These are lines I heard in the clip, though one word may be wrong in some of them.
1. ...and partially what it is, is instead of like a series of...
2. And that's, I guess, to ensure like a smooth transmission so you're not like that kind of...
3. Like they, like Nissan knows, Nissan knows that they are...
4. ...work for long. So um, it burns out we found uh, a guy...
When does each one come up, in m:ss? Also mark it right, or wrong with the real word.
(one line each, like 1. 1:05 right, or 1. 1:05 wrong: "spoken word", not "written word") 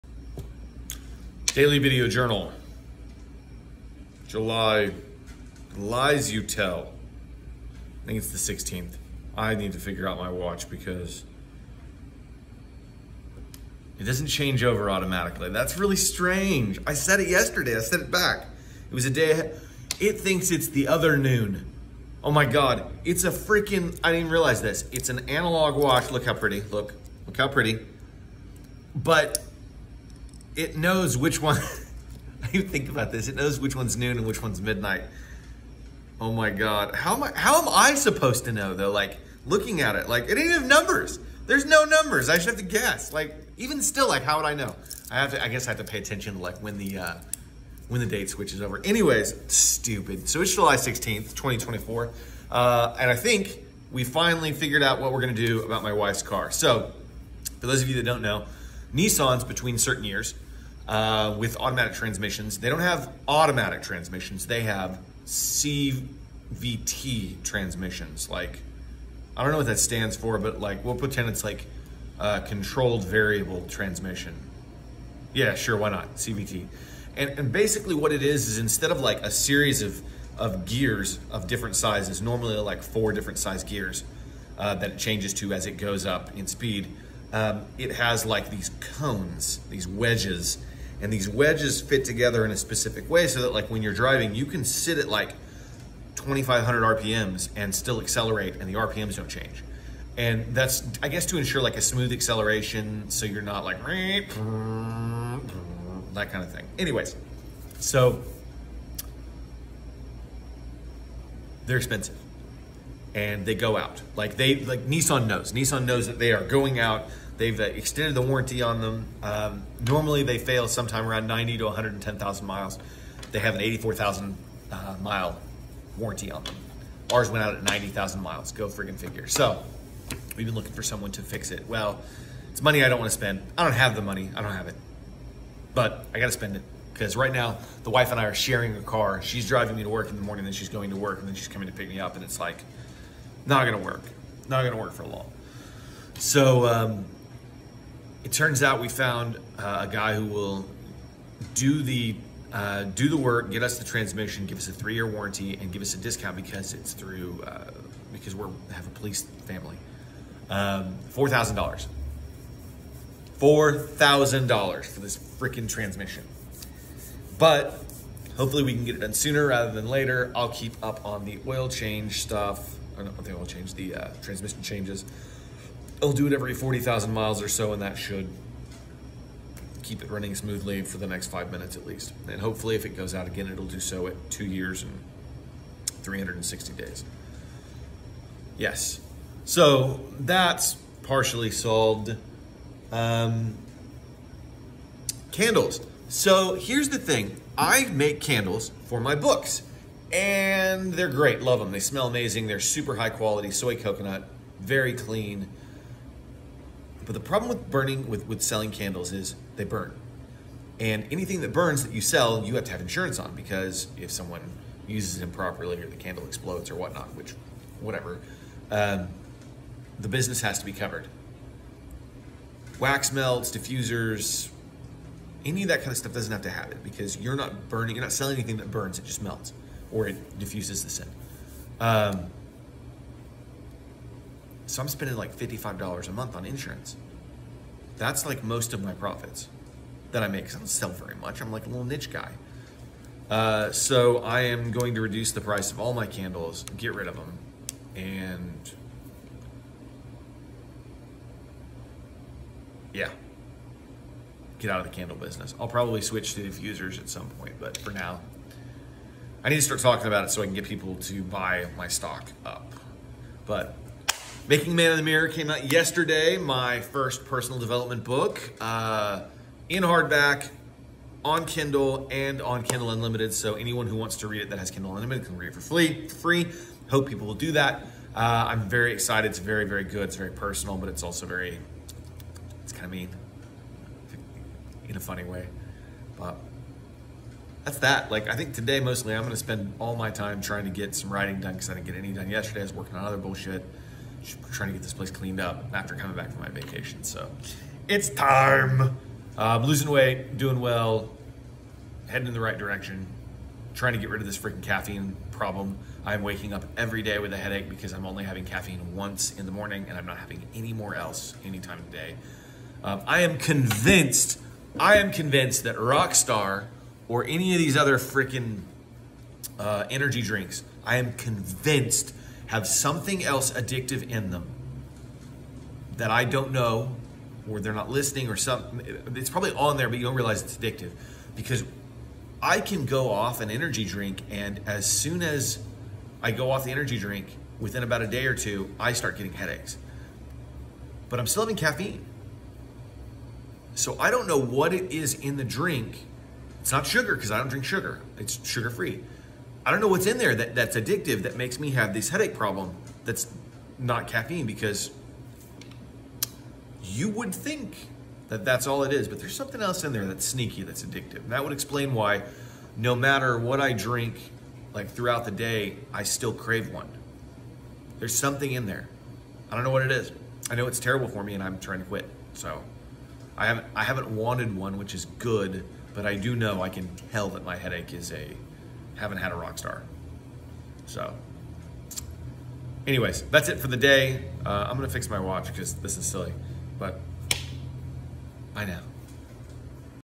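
1. 1:17 wrong: "basically", not "partially"
2. 1:40 wrong: "acceleration", not "transmission"
3. 1:54 right
4. 2:24 wrong: "turns", not "burns".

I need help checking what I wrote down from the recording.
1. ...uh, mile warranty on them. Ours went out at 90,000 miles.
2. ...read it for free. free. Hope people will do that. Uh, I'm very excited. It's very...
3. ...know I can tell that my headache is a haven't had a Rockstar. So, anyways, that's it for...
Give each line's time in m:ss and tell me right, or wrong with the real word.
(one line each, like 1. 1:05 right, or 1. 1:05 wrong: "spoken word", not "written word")
1. 2:04 right
2. 4:35 right
3. 6:16 right.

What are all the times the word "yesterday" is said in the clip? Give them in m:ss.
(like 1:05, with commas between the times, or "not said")
0:17, 4:25, 4:52.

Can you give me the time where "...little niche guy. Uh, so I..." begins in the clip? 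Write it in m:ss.
4:01.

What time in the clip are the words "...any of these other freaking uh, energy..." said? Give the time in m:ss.
5:17.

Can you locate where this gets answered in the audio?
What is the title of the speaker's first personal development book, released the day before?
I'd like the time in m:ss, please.
4:24.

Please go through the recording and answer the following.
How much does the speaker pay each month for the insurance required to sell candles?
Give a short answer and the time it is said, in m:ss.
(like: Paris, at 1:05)
$55, at 3:55.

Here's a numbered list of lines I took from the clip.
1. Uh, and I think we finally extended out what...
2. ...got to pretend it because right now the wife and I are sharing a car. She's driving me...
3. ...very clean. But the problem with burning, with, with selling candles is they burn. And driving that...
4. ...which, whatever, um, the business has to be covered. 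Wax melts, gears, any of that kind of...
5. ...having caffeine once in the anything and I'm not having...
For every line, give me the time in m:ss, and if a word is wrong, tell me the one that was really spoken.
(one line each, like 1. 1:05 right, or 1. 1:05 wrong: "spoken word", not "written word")
1. 0:52 wrong: "figured", not "extended"
2. 2:16 wrong: "spend", not "pretend"
3. 3:24 wrong: "anything", not "driving"
4. 3:37 wrong: "diffusers", not "gears"
5. 5:08 wrong: "morning", not "anything".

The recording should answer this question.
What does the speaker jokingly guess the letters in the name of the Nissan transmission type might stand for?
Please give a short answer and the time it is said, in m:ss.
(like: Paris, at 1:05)
controlled variable transmission, at 1:12.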